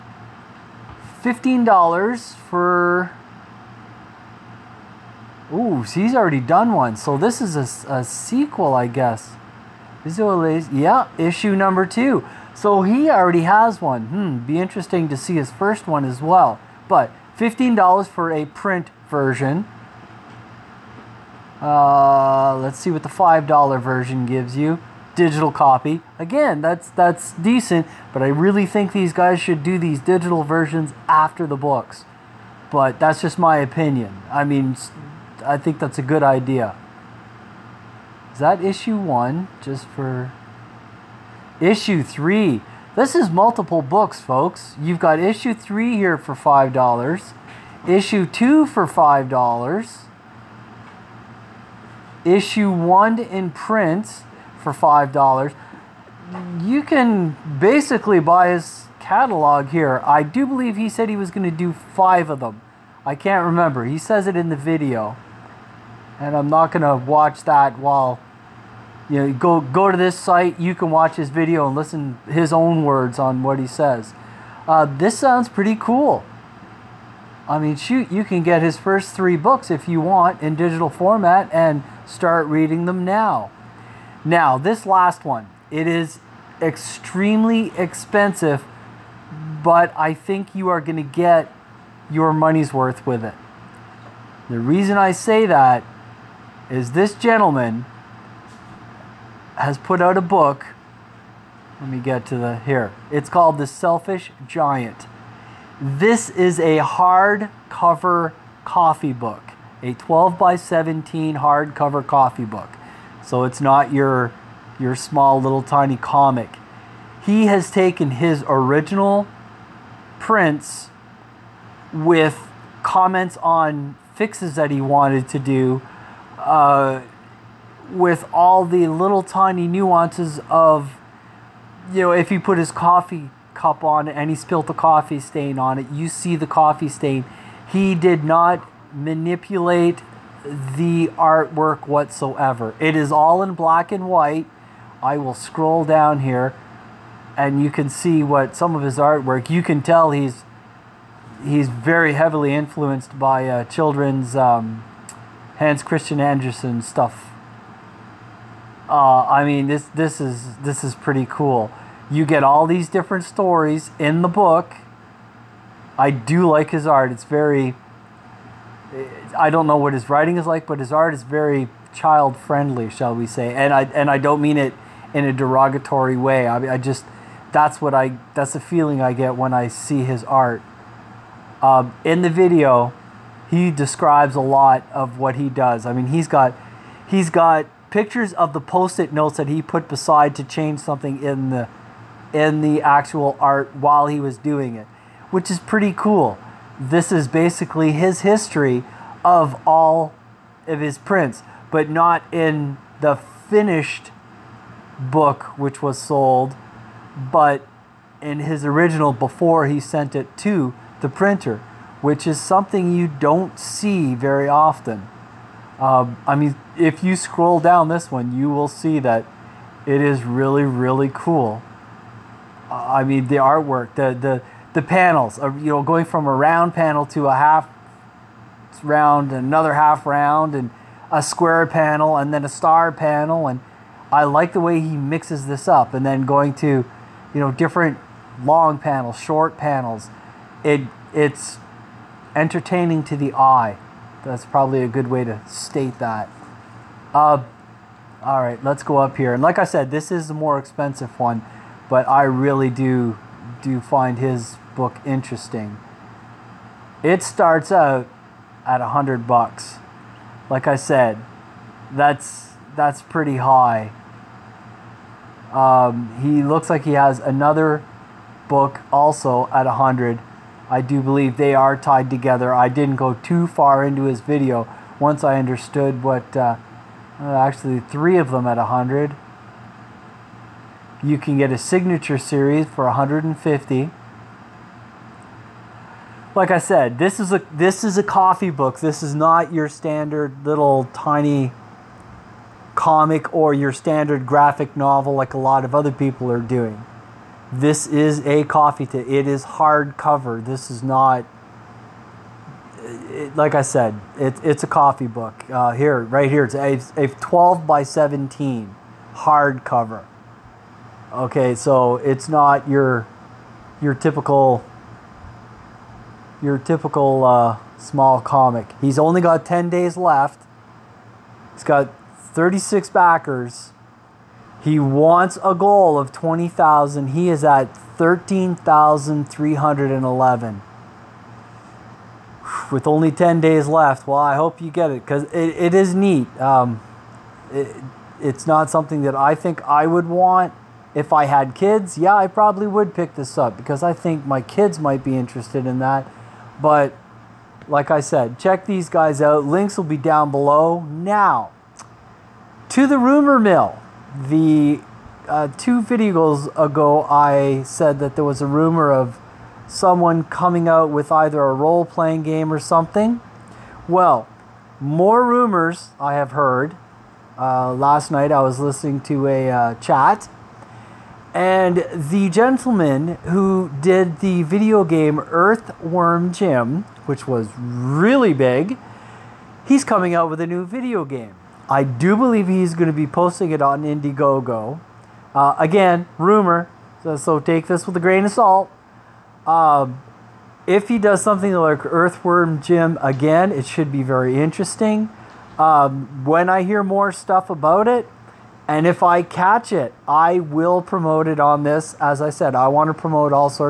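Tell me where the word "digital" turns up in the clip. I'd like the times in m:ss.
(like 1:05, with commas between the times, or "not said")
0:25, 0:29, 1:20.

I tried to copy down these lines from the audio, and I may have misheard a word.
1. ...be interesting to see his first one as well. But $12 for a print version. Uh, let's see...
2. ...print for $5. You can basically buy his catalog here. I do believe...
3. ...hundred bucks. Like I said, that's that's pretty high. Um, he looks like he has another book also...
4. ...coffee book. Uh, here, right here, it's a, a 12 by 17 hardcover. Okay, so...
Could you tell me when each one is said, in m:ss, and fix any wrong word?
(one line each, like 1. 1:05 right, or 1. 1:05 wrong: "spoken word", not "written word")
1. 0:14 wrong: "15", not "12"
2. 0:53 right
3. 4:18 right
4. 5:04 right.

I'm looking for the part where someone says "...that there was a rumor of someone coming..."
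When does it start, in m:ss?
5:57.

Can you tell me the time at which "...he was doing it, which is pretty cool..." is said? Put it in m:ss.
3:14.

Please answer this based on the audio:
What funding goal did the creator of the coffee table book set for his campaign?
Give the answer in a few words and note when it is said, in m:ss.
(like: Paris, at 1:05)
20,000, at 5:26.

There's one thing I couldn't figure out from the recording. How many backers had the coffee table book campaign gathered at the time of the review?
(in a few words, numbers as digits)
36.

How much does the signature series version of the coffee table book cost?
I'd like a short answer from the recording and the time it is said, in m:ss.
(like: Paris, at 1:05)
$150, at 4:42.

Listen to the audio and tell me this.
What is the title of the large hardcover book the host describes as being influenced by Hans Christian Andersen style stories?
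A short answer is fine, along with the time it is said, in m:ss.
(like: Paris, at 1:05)
The Selfish Giant, at 1:43.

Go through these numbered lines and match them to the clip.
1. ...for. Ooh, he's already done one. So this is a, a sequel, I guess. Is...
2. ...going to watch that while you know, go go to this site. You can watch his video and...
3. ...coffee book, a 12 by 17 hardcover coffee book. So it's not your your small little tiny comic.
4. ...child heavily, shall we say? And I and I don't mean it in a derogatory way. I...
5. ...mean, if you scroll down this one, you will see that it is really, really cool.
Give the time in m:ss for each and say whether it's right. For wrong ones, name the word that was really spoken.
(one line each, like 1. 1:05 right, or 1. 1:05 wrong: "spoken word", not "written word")
1. 0:02 right
2. 1:06 right
3. 1:48 right
4. 2:51 wrong: "friendly", not "heavily"
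5. 3:36 right.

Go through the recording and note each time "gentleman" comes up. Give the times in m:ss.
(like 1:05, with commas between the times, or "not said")
1:37, 6:12.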